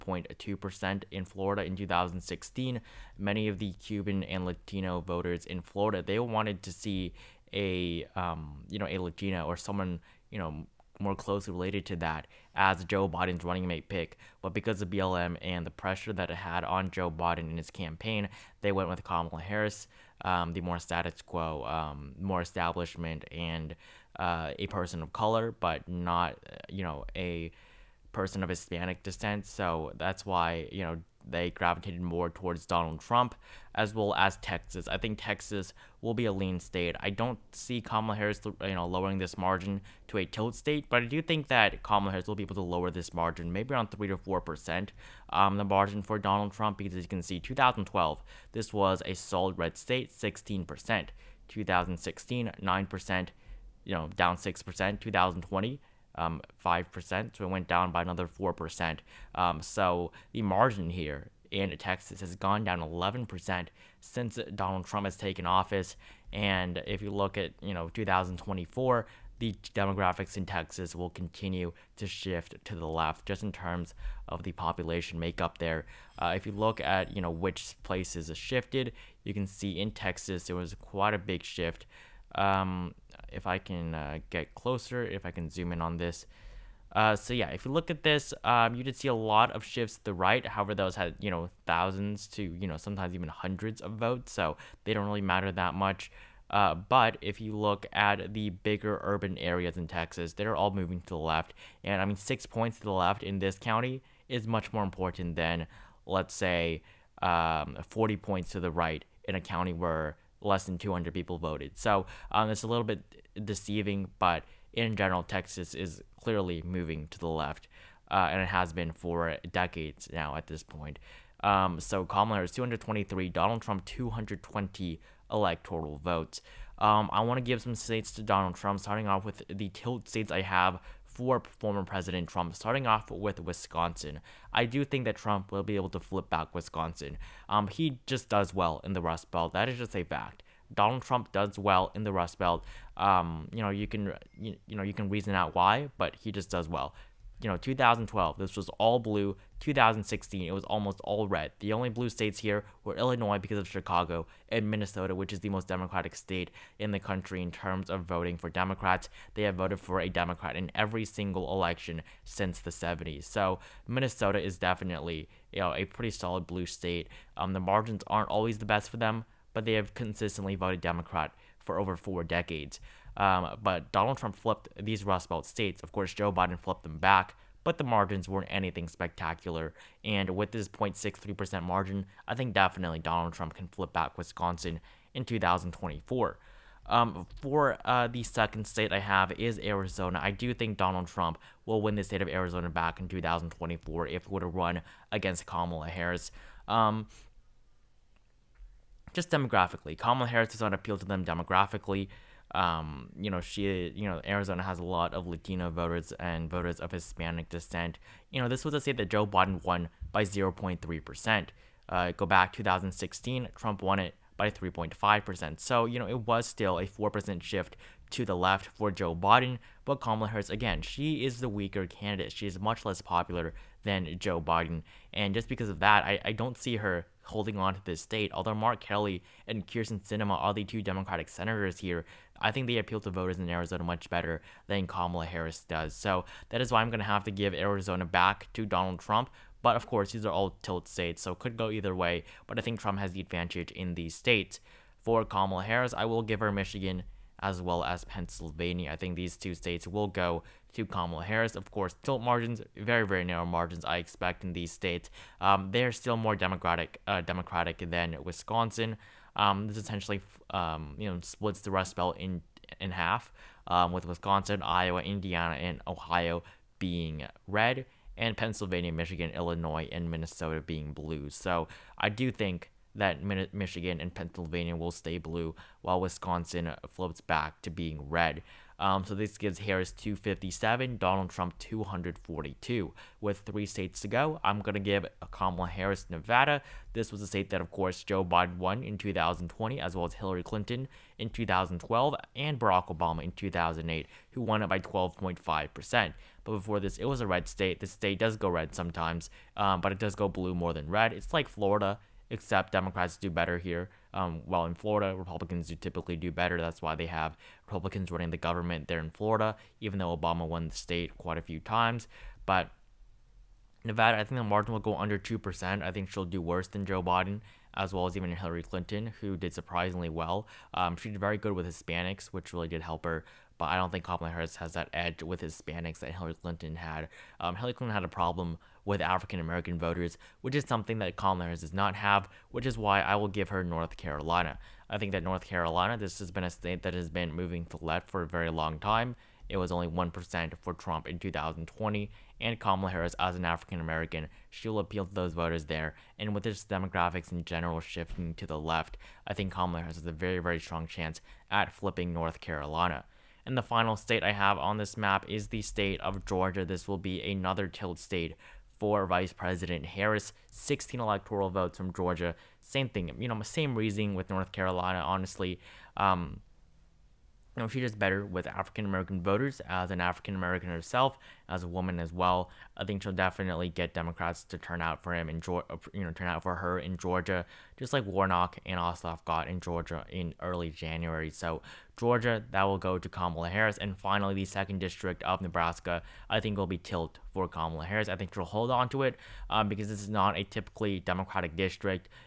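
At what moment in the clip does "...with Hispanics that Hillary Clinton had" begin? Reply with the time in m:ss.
5:25.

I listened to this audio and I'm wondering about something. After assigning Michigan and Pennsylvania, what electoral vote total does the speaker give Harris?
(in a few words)
257.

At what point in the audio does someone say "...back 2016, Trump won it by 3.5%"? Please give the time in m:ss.
3:32.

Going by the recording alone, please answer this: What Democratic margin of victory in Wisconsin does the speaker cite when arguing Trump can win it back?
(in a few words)
0.63%.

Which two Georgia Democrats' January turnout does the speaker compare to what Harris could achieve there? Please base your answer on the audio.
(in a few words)
Warnock and Ossoff.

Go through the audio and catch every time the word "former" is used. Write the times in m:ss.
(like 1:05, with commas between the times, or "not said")
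2:11.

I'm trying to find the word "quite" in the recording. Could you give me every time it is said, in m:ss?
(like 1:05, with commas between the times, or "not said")
1:20, 5:11.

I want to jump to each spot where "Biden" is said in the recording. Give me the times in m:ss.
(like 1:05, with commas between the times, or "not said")
0:13, 0:17, 2:56, 3:29, 3:39, 3:44, 4:48, 5:17.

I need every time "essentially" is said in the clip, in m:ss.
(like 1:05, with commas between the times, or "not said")
4:19.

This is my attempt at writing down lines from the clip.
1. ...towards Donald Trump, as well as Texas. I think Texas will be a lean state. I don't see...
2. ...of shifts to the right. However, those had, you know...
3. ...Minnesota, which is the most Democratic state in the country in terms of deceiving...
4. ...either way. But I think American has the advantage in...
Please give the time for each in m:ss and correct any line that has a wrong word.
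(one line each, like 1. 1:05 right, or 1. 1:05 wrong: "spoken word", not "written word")
1. 0:32 right
2. 1:29 right
3. 2:34 wrong: "voting", not "deceiving"
4. 4:01 wrong: "Trump", not "American".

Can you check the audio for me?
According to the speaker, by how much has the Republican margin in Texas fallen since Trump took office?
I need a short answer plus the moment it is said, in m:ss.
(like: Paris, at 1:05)
11%, at 1:02.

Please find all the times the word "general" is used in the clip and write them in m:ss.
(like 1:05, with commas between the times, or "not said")
1:54, 5:47.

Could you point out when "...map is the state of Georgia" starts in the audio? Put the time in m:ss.
5:54.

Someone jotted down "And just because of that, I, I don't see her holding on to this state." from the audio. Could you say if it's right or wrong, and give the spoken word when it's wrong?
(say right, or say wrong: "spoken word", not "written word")
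right.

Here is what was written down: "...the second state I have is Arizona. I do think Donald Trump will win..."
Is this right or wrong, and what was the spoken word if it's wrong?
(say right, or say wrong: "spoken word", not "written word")
right.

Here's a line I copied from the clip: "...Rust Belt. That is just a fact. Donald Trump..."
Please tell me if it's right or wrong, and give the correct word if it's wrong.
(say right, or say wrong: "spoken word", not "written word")
right.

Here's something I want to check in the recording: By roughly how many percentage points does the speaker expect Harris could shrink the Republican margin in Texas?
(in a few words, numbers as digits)
3 to 4 percent.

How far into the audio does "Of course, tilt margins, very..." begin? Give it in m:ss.
4:11.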